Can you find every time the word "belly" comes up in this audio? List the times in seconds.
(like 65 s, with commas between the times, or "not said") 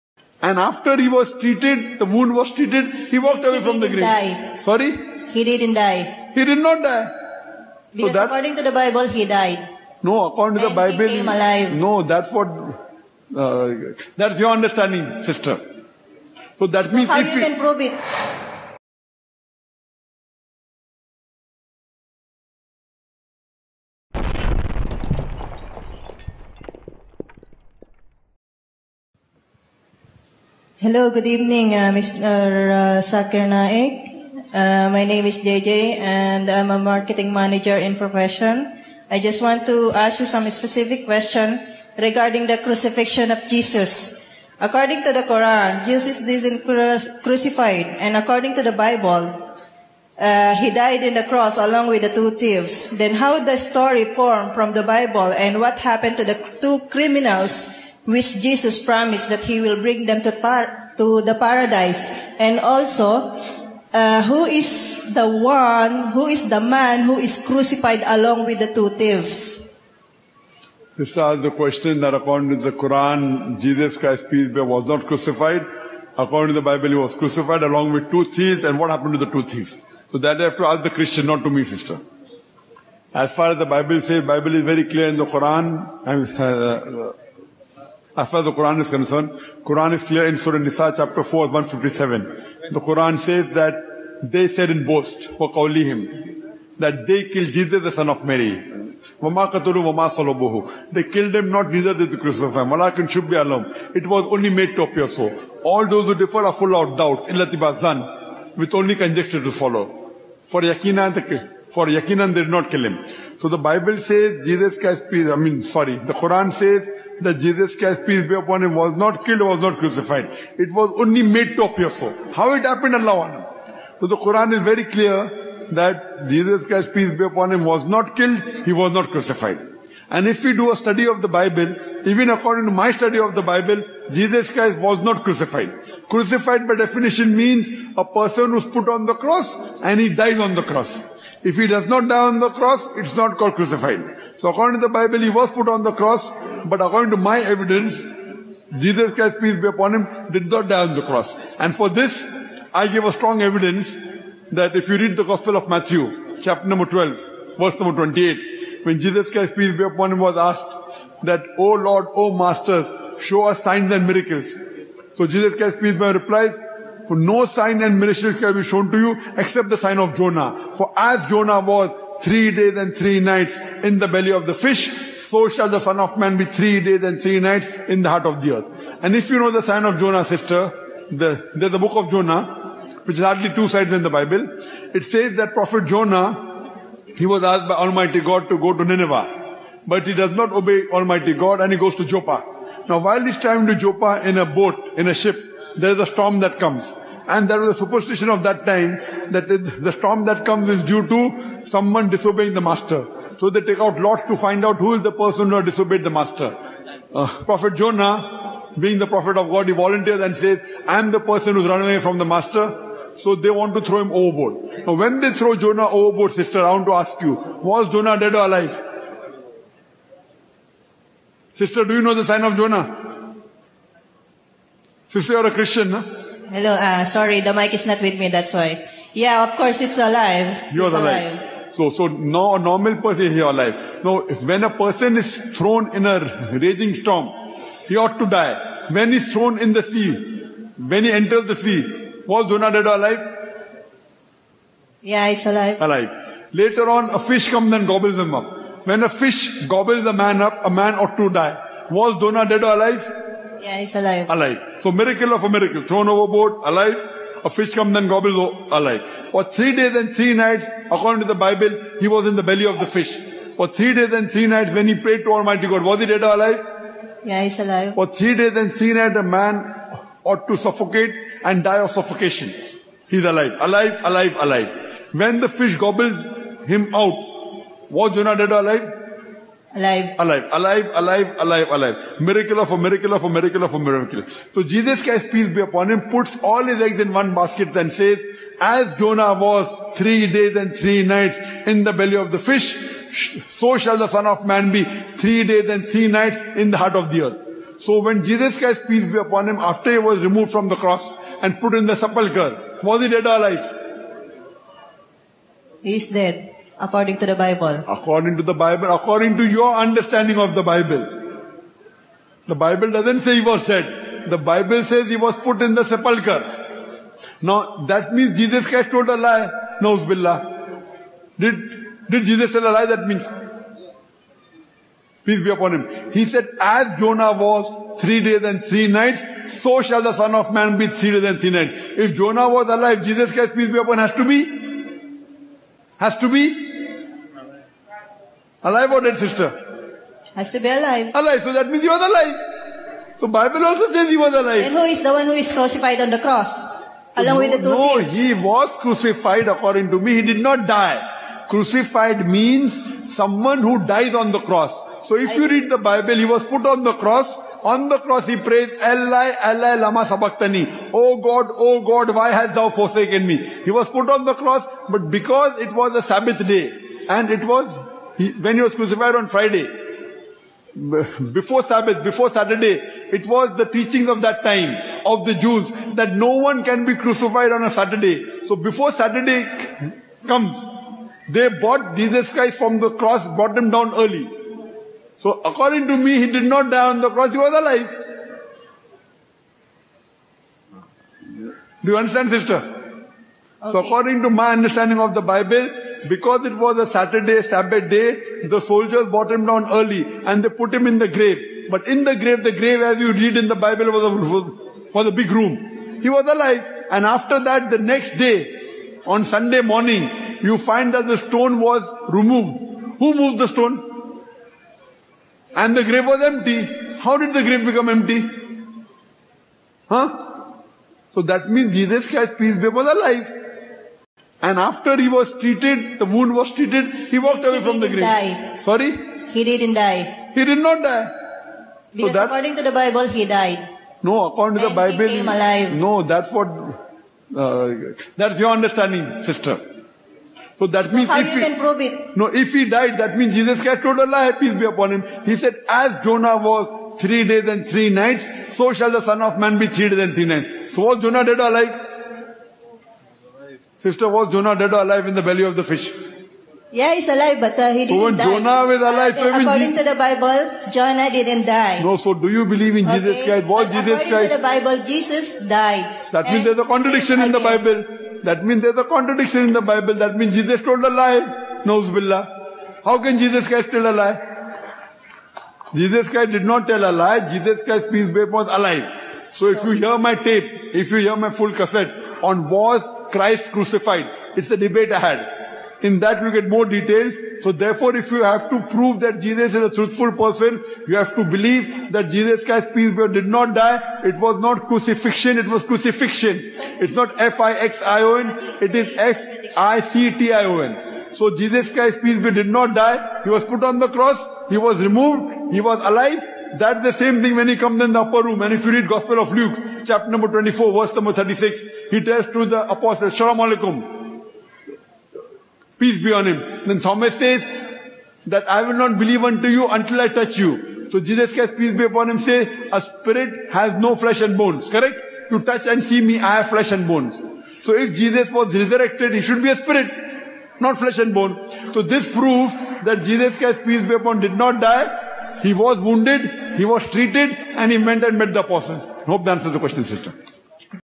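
174 s, 262 s, 291 s, 455 s.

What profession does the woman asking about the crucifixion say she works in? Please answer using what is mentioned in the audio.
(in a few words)
Marketing manager.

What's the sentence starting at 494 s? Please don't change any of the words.
It was not crucifixion, it was crucifiction.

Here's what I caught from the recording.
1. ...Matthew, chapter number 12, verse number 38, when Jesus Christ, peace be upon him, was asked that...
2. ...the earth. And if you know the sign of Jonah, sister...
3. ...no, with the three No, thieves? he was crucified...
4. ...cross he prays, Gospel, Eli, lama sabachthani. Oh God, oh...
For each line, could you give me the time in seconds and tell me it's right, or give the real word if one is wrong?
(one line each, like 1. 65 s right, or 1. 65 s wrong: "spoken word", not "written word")
1. 155 s wrong: "28", not "38"
2. 178 s right
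3. 347 s wrong: "two", not "three"
4. 357 s wrong: "Eli", not "Gospel".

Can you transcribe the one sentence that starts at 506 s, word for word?
That's the same thing when he comes in the upper room.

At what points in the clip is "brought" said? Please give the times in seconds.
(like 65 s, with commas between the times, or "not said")
383 s, 399 s.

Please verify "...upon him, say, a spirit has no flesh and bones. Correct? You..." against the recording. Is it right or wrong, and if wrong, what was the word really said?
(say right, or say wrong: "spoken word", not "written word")
right.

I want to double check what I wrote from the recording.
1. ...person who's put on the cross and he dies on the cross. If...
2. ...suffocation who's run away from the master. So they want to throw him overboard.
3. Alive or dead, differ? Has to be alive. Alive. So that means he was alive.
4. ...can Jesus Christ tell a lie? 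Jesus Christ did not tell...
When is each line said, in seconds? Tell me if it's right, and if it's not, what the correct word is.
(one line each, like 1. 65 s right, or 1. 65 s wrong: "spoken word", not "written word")
1. 138 s right
2. 211 s wrong: "person", not "suffocation"
3. 338 s wrong: "sister", not "differ"
4. 473 s right.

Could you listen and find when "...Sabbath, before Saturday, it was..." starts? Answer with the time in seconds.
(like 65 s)
371 s.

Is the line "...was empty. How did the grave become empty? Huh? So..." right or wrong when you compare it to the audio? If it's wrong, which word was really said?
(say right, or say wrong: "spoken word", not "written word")
right.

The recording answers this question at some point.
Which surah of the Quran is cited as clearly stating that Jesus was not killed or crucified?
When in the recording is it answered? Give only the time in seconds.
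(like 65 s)
90 s.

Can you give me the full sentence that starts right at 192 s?
Now while he's traveling to Joppa in a boat, in a ship, there's a storm that comes.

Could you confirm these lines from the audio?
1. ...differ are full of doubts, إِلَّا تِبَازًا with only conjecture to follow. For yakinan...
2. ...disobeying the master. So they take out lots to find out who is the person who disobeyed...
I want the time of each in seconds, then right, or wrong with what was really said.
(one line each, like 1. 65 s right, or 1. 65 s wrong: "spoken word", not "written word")
1. 106 s right
2. 202 s right.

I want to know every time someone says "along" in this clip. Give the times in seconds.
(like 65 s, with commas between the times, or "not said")
51 s, 68 s, 77 s, 347 s.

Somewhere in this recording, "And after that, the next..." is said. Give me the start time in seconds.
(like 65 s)
406 s.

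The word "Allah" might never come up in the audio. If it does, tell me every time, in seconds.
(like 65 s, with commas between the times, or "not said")
122 s, 443 s.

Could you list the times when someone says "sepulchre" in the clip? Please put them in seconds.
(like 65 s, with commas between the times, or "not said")
301 s, 315 s.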